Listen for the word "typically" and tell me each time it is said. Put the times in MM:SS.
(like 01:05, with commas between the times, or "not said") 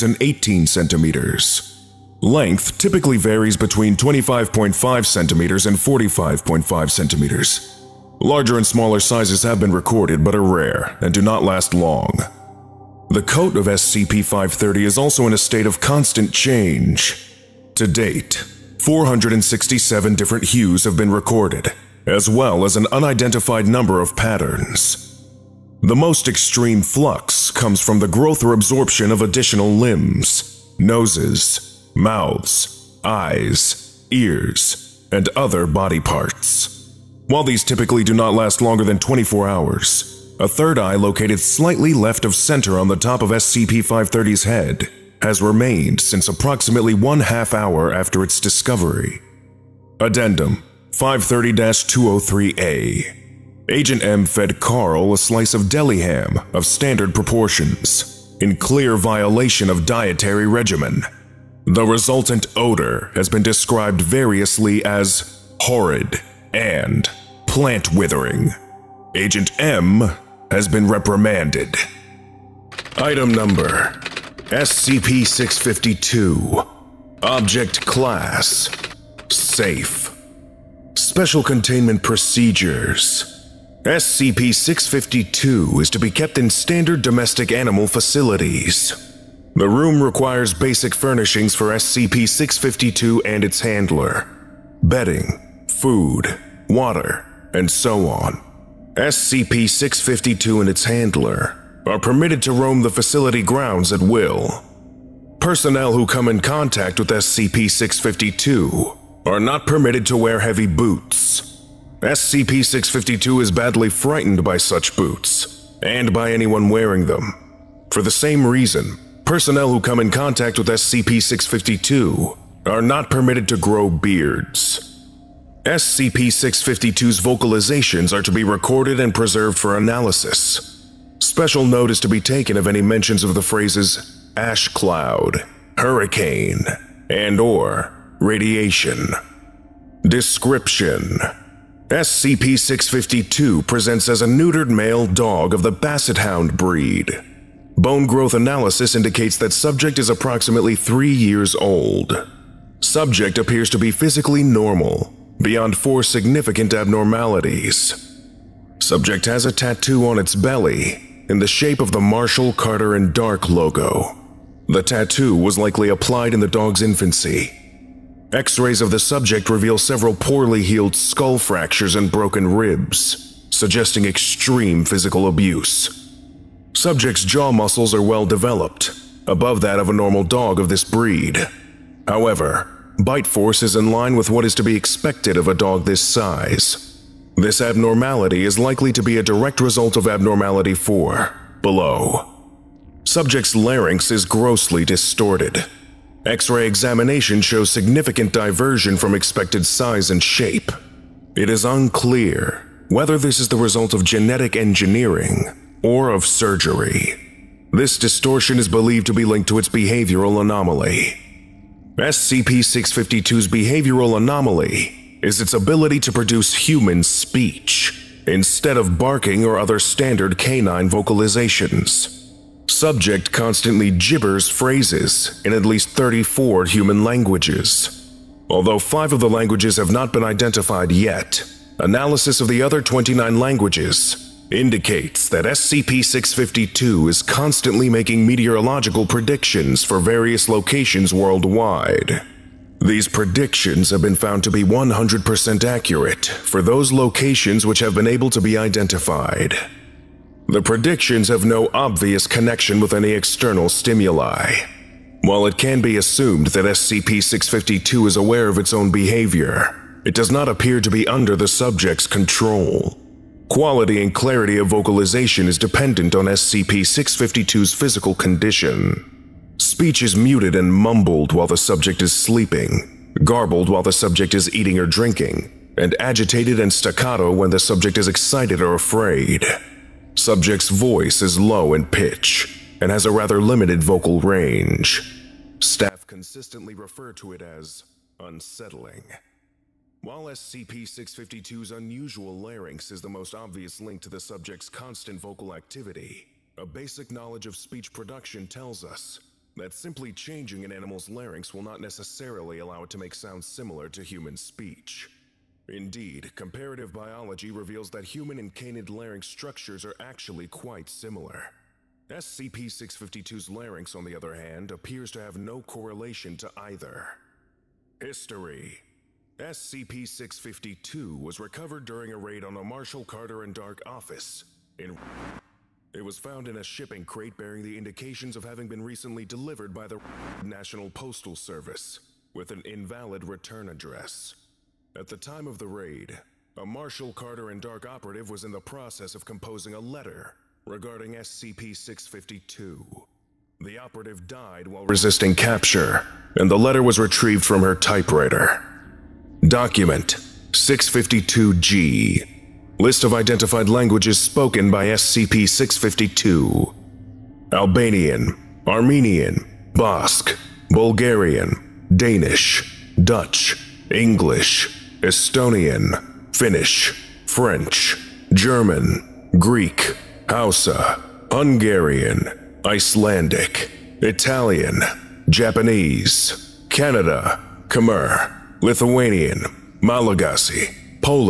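00:02, 00:37.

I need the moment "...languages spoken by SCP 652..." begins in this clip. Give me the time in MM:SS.
05:53.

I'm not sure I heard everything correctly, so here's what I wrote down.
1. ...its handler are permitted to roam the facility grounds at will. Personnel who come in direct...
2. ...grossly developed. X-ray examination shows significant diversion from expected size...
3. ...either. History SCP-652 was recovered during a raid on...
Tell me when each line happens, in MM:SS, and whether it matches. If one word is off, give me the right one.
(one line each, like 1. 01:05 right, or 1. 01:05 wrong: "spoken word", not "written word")
1. 01:40 wrong: "contact", not "direct"
2. 03:14 wrong: "distorted", not "developed"
3. 05:16 right.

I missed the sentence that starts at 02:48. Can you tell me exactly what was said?
X-rays of the subject reveal several poorly healed skull fractures and broken ribs, suggesting extreme physical abuse.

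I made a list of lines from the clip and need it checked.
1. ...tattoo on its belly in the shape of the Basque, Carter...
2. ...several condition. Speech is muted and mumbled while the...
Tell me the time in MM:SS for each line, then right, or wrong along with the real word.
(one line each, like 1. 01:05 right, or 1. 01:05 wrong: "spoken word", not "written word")
1. 02:39 wrong: "Marshall", not "Basque"
2. 04:27 wrong: "physical", not "several".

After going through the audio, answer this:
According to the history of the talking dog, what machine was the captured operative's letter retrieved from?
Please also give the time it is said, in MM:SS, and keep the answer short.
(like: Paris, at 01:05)
her typewriter, at 05:47.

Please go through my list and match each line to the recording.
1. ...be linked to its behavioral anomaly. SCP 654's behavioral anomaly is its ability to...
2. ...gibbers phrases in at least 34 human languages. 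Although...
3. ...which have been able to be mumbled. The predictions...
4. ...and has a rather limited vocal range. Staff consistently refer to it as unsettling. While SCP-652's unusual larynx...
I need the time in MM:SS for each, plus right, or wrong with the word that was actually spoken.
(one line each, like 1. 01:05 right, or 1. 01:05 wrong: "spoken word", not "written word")
1. 03:29 wrong: "652", not "654"
2. 03:43 right
3. 04:07 wrong: "identified", not "mumbled"
4. 04:42 right.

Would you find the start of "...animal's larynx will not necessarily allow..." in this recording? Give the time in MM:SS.
05:00.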